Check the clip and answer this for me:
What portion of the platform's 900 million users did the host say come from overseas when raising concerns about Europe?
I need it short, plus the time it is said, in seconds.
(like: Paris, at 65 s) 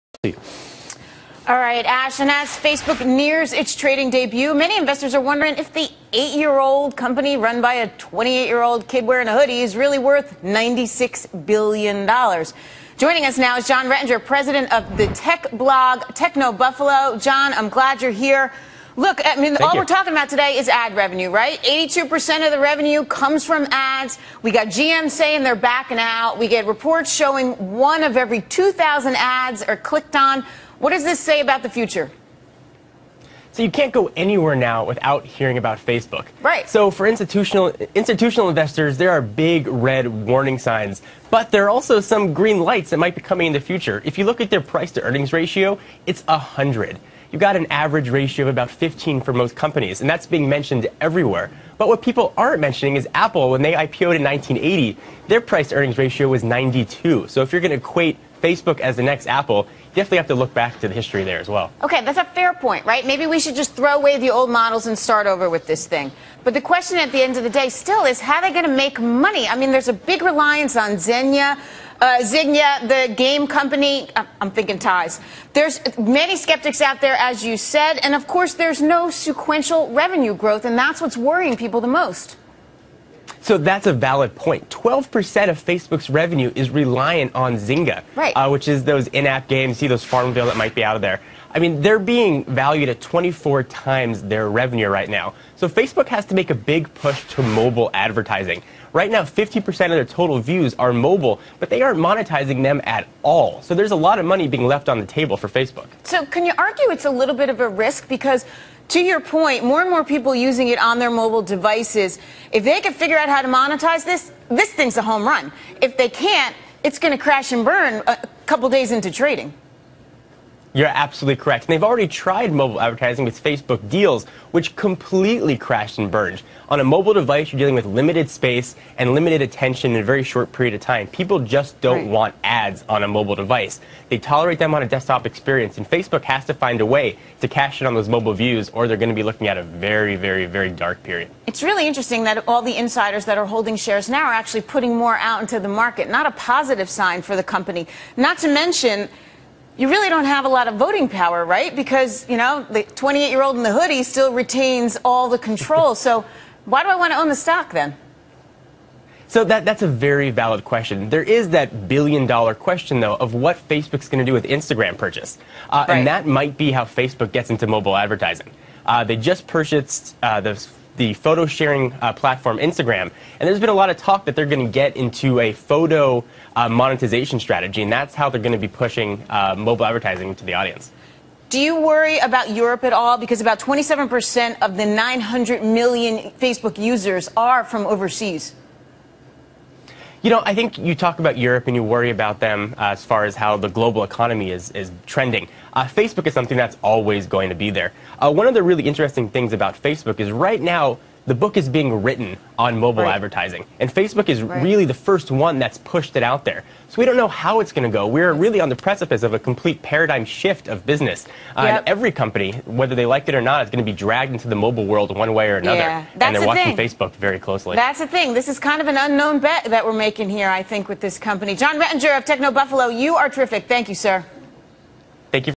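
27%, at 183 s.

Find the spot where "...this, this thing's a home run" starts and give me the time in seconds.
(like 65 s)
114 s.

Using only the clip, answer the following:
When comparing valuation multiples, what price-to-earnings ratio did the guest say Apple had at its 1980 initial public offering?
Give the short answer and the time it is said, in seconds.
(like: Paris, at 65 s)
92, at 56 s.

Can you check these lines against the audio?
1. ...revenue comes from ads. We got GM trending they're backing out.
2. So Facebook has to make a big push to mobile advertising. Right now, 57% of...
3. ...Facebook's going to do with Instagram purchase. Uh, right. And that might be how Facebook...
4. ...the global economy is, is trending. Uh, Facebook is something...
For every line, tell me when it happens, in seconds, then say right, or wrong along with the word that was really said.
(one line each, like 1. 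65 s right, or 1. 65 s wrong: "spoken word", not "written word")
1. 22 s wrong: "saying", not "trending"
2. 95 s wrong: "50", not "57"
3. 163 s right
4. 193 s right.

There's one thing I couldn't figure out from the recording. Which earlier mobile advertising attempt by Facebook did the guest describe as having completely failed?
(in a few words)
Facebook Deals.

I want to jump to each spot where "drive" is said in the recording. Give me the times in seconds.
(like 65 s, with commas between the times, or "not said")
not said.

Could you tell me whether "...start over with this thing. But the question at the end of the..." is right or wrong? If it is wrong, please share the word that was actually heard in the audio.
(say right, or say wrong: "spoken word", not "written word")
right.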